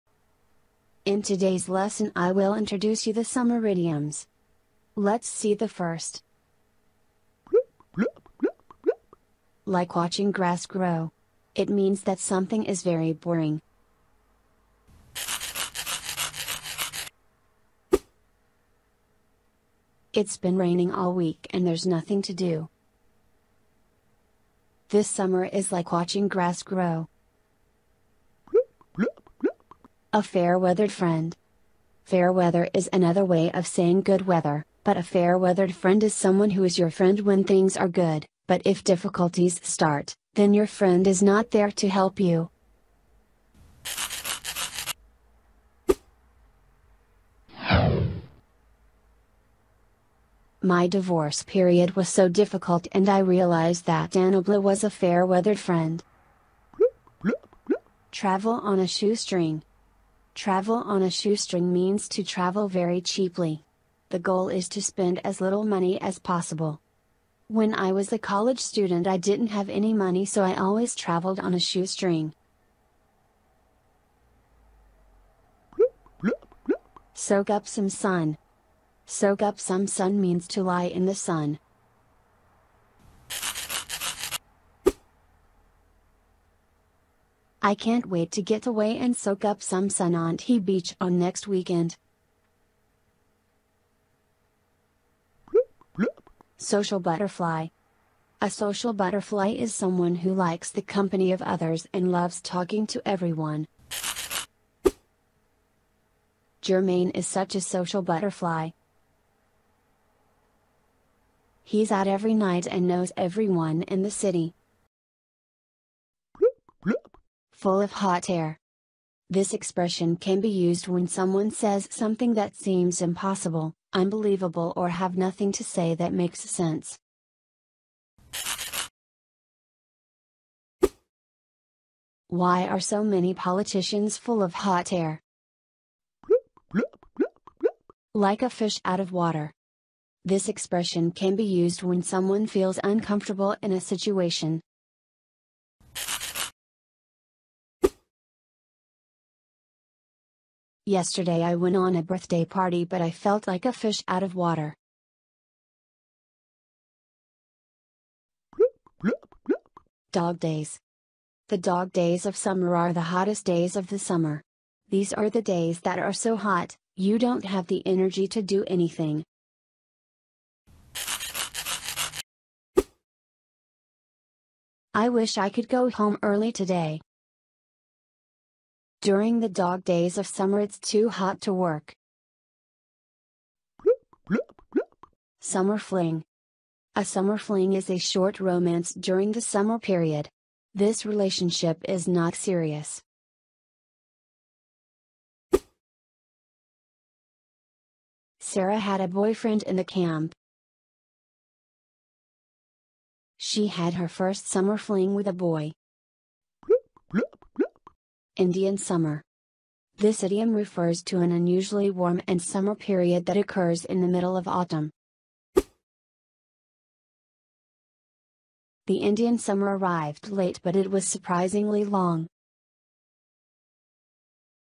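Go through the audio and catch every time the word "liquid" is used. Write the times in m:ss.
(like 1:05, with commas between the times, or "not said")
not said.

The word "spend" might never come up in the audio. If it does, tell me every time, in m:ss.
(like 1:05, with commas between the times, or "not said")
1:04.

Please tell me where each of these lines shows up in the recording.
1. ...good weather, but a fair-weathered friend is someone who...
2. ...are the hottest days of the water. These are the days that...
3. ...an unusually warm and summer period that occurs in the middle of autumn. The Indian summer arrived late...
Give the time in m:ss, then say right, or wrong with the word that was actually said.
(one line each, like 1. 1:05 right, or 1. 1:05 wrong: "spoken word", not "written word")
1. 0:34 right
2. 2:42 wrong: "summer", not "water"
3. 3:31 right.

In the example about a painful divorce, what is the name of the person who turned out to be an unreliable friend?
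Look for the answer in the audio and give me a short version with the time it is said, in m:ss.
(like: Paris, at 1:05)
Danobla, at 0:54.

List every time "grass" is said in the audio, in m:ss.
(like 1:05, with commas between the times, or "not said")
0:10, 0:26.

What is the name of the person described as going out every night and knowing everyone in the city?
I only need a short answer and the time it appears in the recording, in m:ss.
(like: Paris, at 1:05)
Germaine, at 1:46.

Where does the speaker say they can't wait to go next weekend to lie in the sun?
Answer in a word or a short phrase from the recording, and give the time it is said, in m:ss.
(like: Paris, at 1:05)
T Beach, at 1:30.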